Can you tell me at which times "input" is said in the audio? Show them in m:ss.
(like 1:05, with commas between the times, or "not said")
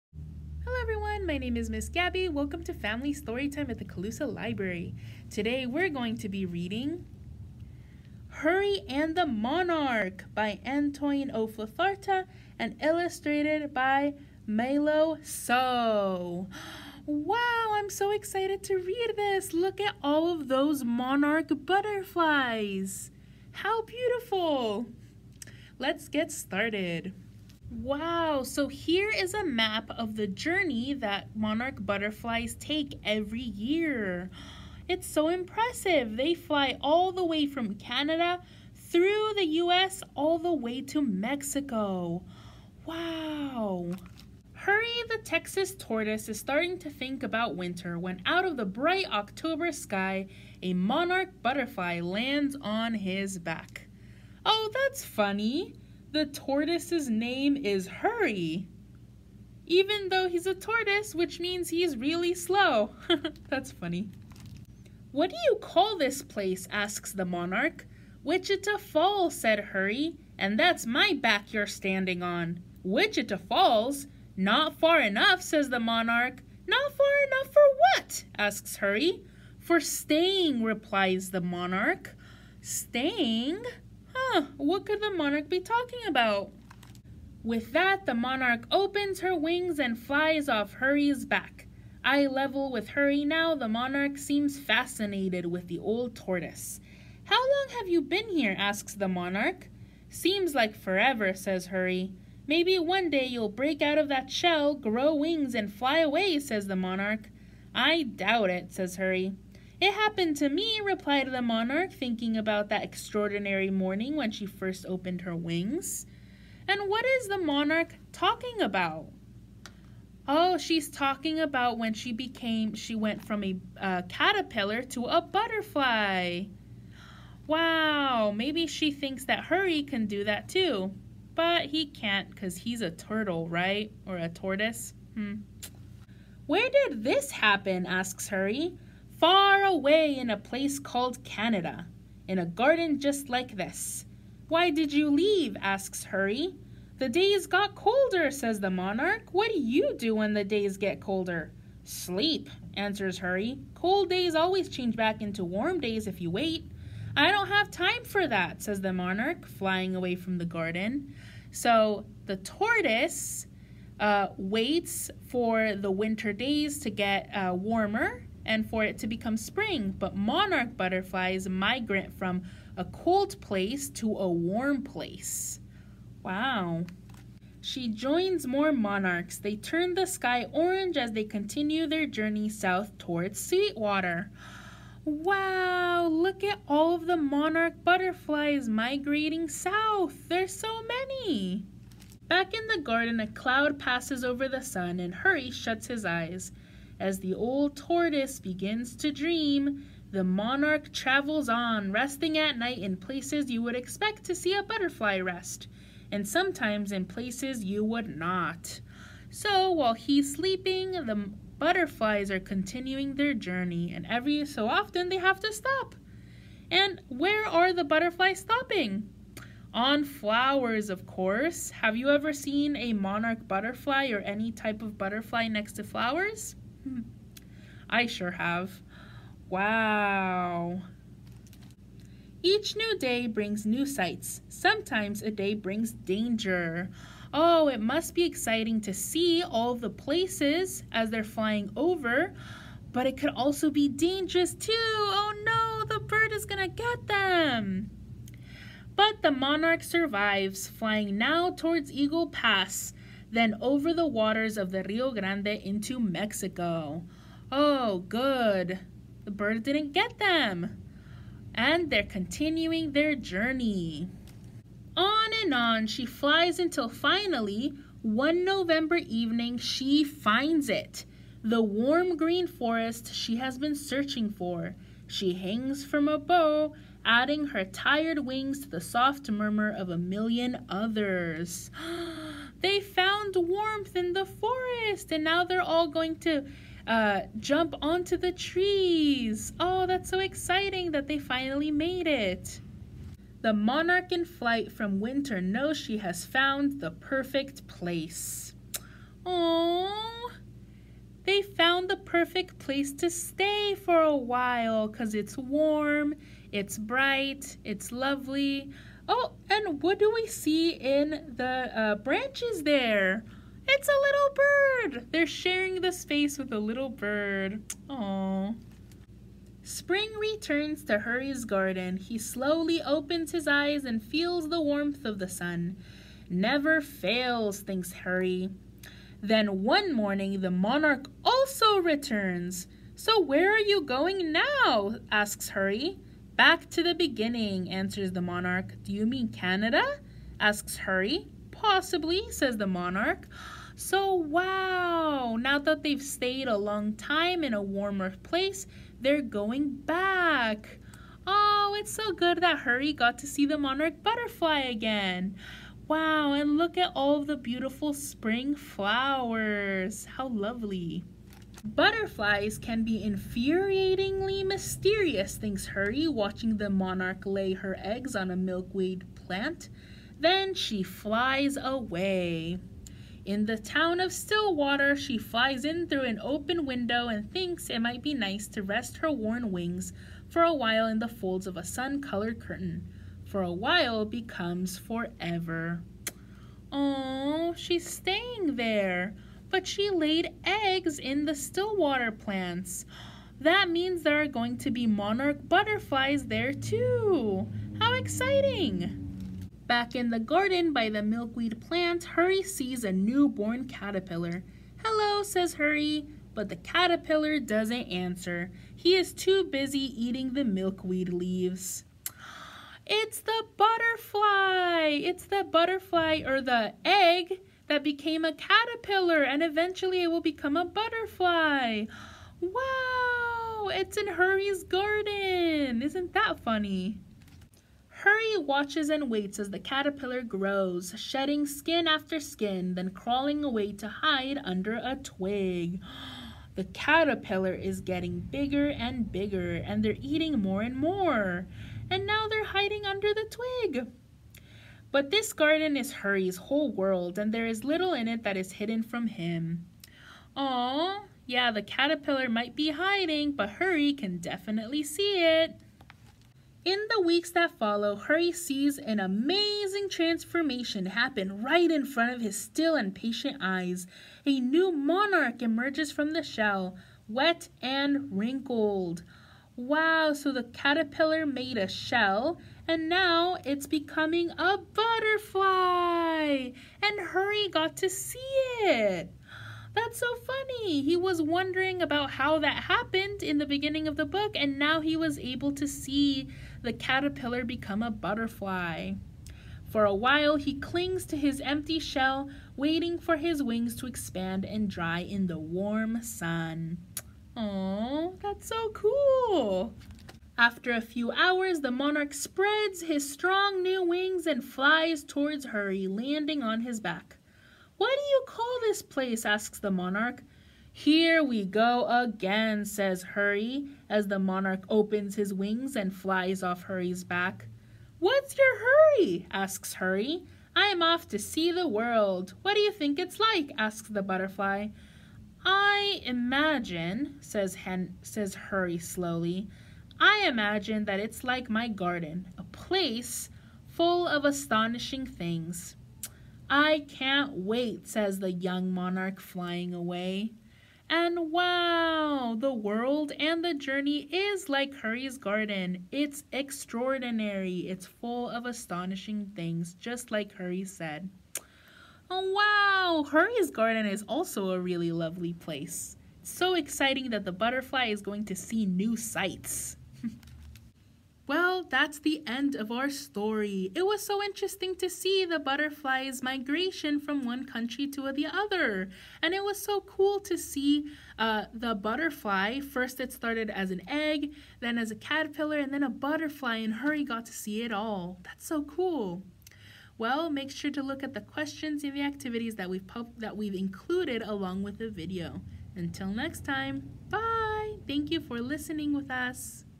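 not said.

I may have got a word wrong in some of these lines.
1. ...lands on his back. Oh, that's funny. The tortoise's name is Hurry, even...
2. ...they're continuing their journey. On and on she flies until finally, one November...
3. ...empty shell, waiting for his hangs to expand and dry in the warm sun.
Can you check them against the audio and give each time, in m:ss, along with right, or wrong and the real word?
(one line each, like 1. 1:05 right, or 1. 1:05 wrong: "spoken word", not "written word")
1. 0:52 right
2. 4:21 right
3. 8:11 wrong: "wings", not "hangs".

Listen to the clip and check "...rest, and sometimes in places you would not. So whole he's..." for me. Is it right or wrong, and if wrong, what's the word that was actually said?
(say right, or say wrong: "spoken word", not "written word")
wrong: "while", not "whole".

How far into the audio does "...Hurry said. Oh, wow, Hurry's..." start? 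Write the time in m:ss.
9:10.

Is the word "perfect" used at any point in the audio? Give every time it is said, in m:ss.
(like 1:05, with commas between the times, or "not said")
4:56, 5:01.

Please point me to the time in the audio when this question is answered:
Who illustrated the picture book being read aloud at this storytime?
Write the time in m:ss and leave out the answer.
0:14.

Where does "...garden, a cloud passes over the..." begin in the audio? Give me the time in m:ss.
3:12.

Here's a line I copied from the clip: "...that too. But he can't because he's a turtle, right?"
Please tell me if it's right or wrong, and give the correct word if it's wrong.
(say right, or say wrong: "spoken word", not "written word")
right.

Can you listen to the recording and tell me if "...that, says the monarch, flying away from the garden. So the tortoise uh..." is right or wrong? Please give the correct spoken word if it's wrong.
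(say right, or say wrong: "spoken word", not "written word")
right.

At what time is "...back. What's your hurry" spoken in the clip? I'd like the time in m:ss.
8:37.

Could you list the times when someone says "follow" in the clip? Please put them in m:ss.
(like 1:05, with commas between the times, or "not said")
7:37.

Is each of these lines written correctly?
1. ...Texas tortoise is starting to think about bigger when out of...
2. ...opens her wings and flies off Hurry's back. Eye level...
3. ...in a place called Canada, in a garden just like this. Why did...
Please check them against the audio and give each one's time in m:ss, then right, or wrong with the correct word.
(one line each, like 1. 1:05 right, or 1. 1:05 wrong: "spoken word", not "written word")
1. 0:45 wrong: "winter", not "bigger"
2. 1:28 right
3. 2:20 right.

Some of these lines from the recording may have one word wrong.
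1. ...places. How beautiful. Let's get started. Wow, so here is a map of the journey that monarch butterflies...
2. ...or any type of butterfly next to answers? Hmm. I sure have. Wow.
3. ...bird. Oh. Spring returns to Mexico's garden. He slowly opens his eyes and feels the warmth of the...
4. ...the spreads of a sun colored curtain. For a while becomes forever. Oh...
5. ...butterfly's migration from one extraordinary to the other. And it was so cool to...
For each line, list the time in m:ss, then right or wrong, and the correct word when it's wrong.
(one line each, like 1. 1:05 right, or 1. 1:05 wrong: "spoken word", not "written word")
1. 0:21 wrong: "butterflies", not "places"
2. 3:44 wrong: "flowers", not "answers"
3. 5:16 wrong: "Hurry", not "Mexico"
4. 6:20 wrong: "folds", not "spreads"
5. 9:25 wrong: "country", not "extraordinary".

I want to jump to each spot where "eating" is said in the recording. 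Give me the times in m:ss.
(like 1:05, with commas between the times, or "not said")
6:50, 7:20.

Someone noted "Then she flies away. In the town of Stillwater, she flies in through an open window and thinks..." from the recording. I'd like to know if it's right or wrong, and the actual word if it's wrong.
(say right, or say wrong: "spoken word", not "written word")
right.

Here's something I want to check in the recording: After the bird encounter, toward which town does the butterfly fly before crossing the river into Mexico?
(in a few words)
Eagle Pass.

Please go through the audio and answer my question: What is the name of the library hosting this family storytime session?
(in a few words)
Colusa Library.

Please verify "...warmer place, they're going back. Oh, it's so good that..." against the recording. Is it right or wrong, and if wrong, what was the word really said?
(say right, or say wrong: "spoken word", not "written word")
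right.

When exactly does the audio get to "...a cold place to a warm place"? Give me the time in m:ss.
2:52.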